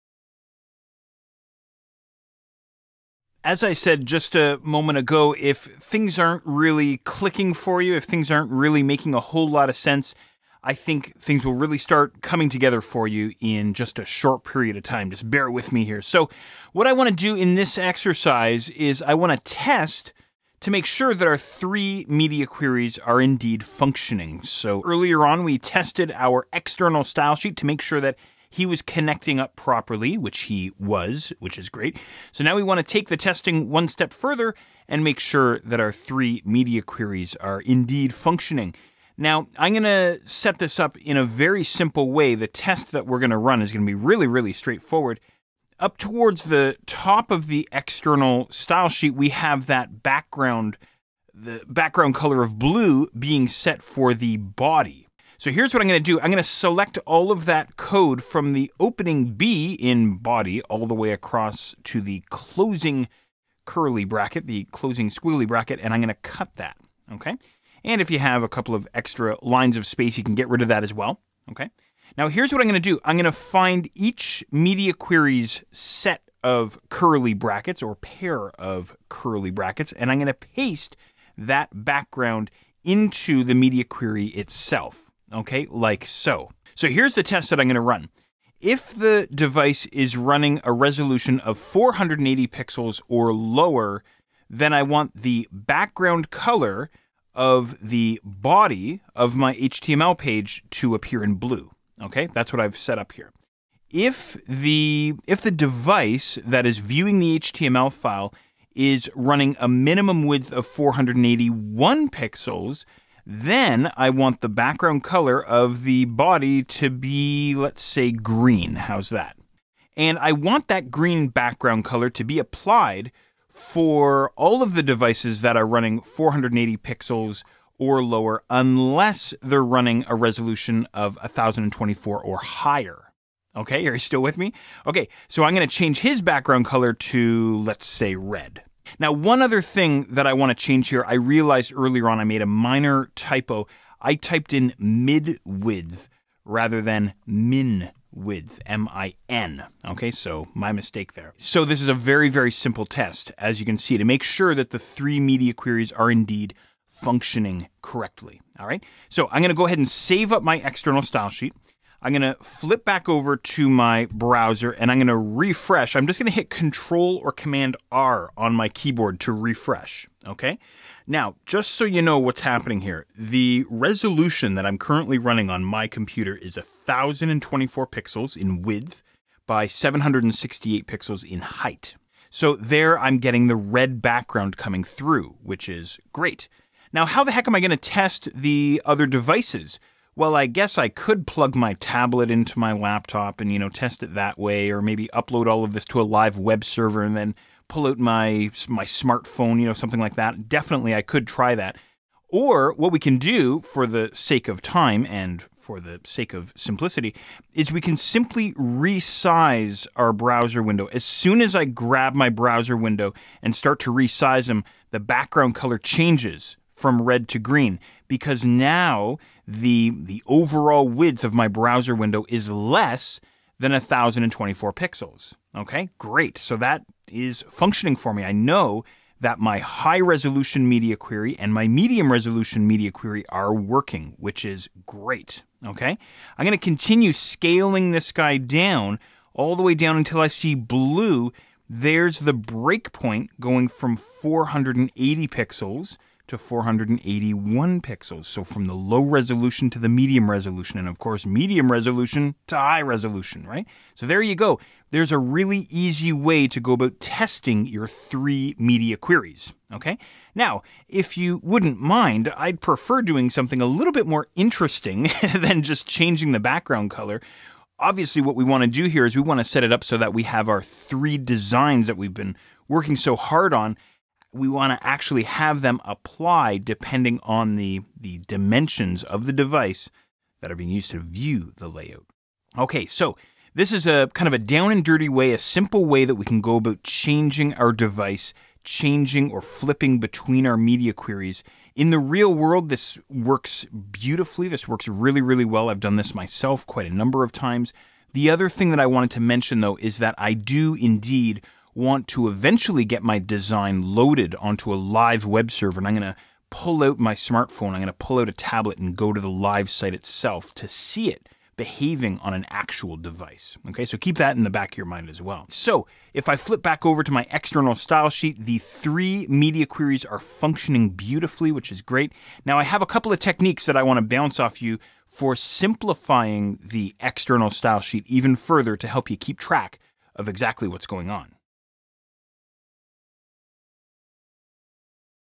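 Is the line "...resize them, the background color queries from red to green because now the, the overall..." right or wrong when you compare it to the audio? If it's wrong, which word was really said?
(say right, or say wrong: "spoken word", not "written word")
wrong: "changes", not "queries".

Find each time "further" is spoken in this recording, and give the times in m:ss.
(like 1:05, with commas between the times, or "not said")
0:34, 5:28.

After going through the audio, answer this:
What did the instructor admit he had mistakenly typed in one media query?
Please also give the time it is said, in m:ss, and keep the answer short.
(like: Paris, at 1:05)
mid width, at 2:24.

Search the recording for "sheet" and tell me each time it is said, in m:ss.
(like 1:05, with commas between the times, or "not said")
0:27, 0:48, 2:41, 5:18, 5:27.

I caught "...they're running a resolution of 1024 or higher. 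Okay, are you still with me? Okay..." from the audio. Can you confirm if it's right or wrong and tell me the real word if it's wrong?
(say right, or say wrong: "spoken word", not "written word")
right.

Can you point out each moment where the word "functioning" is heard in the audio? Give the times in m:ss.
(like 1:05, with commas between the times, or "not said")
0:23, 0:38, 2:36, 3:47, 5:20.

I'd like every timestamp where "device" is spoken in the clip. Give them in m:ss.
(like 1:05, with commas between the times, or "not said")
1:29, 1:45, 2:04, 3:09, 4:39, 4:47, 5:12.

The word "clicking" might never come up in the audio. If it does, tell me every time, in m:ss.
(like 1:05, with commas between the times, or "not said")
0:06.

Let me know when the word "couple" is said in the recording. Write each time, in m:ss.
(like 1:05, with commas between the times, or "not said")
1:08, 5:22.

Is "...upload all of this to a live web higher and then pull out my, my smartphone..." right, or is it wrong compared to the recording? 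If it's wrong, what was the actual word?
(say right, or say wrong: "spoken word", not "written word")
wrong: "server", not "higher".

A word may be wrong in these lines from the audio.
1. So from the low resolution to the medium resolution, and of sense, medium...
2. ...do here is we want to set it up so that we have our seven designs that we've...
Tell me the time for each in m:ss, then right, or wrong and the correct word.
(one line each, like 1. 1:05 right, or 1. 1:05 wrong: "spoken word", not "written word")
1. 4:08 wrong: "course", not "sense"
2. 4:28 wrong: "three", not "seven".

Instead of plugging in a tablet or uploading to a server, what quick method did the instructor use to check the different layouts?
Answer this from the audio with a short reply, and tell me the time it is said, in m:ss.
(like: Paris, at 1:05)
resize our browser window, at 3:28.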